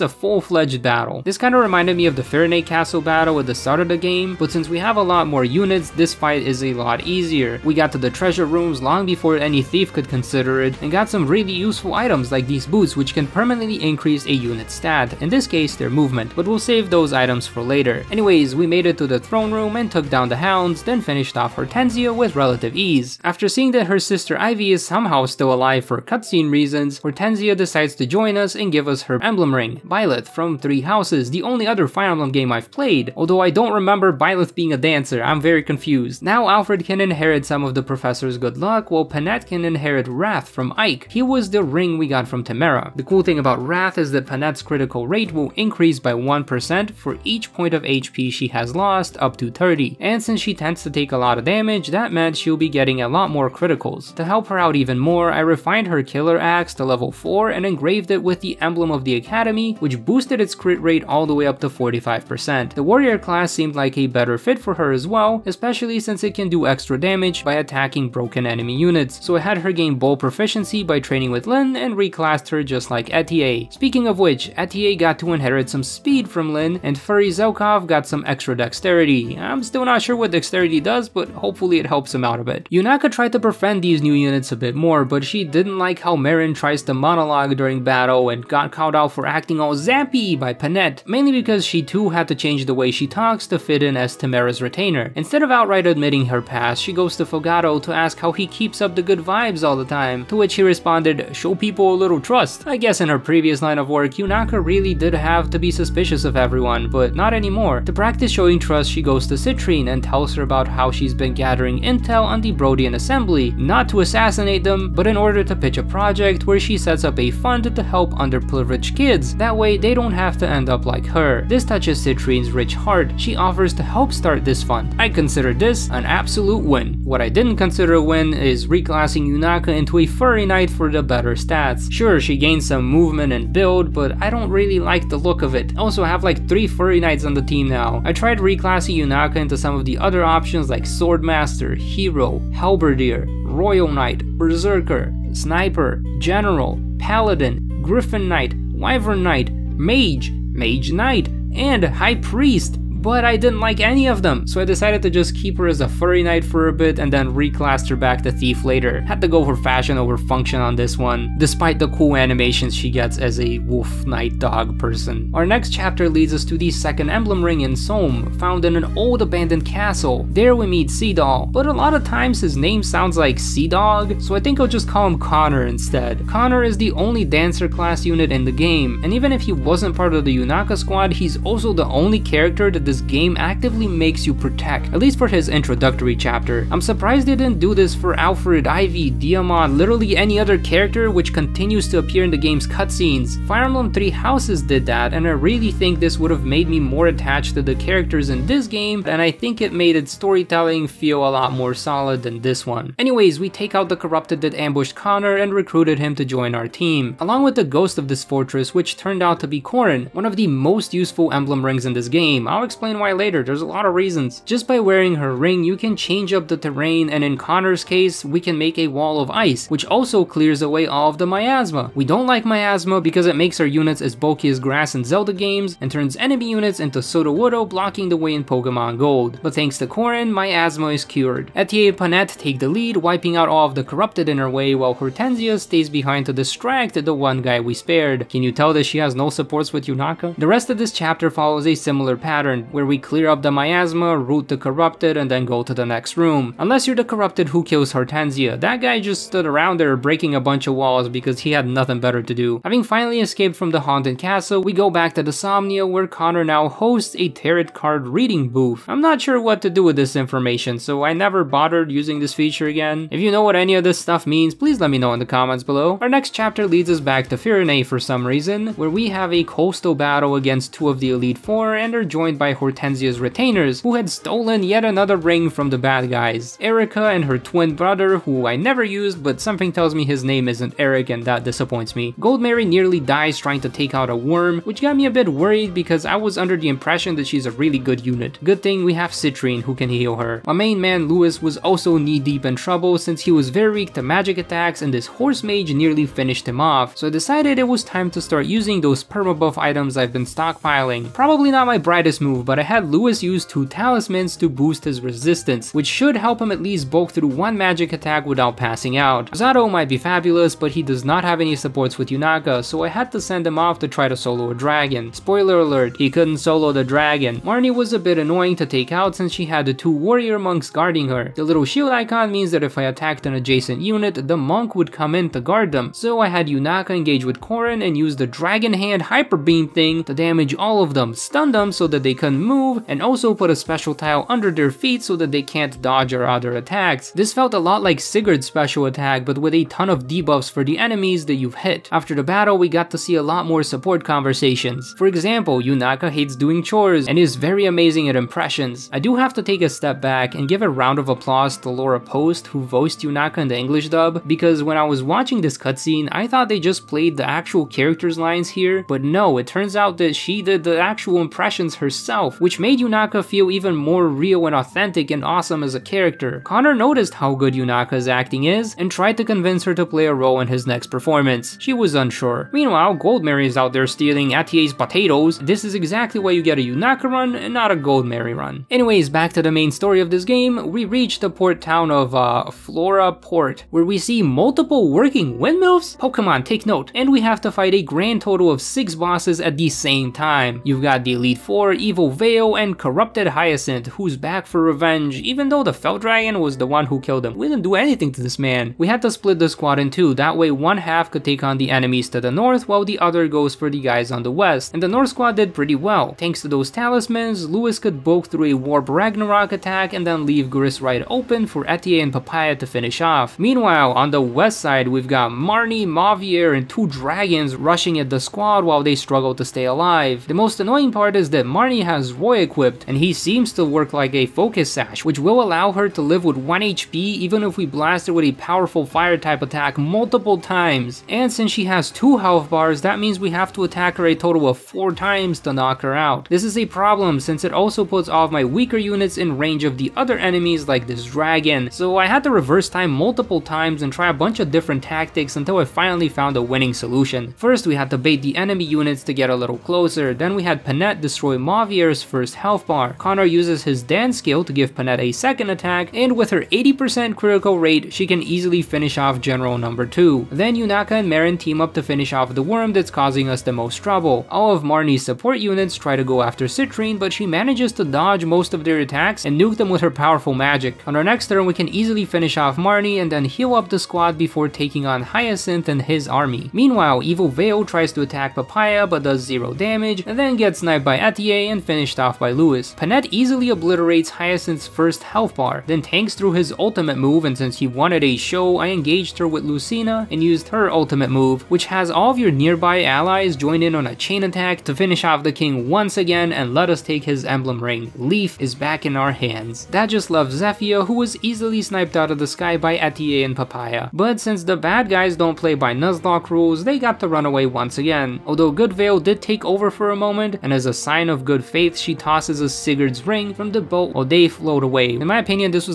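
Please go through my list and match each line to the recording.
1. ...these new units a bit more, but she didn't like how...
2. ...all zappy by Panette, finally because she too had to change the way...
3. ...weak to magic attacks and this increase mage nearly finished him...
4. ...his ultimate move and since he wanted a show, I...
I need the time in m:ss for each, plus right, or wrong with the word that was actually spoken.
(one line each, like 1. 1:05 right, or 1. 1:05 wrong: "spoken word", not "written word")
1. 1:23 right
2. 1:29 wrong: "mainly", not "finally"
3. 4:53 wrong: "horse", not "increase"
4. 8:06 right.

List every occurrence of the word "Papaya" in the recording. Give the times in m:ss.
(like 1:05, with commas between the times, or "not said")
6:52, 7:58, 8:23.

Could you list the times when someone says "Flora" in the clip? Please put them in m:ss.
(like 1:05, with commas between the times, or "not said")
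6:22.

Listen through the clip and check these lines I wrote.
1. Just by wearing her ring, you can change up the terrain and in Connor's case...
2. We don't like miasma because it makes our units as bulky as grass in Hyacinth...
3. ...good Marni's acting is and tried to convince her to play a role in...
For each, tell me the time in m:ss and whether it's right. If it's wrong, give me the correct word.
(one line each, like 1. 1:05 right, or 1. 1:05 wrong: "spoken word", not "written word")
1. 3:34 right
2. 3:41 wrong: "Zelda", not "Hyacinth"
3. 6:07 wrong: "Yunaka", not "Marni".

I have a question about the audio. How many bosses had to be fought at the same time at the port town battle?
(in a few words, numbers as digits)
6.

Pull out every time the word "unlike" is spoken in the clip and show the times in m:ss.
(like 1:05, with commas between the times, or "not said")
not said.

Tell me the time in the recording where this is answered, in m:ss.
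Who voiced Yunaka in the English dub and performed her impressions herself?
5:51.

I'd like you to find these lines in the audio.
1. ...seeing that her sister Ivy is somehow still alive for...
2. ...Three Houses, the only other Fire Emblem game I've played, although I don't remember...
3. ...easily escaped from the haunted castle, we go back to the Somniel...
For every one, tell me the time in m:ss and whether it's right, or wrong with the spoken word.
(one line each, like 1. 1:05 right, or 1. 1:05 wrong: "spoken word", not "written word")
1. 0:23 right
2. 0:30 right
3. 4:12 wrong: "finally", not "easily".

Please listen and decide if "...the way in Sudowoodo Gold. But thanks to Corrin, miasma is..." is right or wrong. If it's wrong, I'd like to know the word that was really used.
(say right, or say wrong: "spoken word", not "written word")
wrong: "Pokemon", not "Sudowoodo".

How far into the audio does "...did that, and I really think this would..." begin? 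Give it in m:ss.
3:14.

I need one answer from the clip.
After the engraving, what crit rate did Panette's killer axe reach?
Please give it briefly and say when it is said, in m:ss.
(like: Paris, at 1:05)
45%, at 1:01.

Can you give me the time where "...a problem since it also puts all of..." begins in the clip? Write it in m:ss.
7:16.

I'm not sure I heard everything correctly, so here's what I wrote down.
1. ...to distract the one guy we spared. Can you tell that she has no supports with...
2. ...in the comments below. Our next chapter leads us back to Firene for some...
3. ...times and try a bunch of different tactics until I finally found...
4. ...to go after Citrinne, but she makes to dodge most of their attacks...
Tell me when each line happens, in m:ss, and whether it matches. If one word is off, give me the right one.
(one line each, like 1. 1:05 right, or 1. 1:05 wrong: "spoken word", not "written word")
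1. 3:56 right
2. 4:25 right
3. 7:23 right
4. 7:45 wrong: "manages", not "makes".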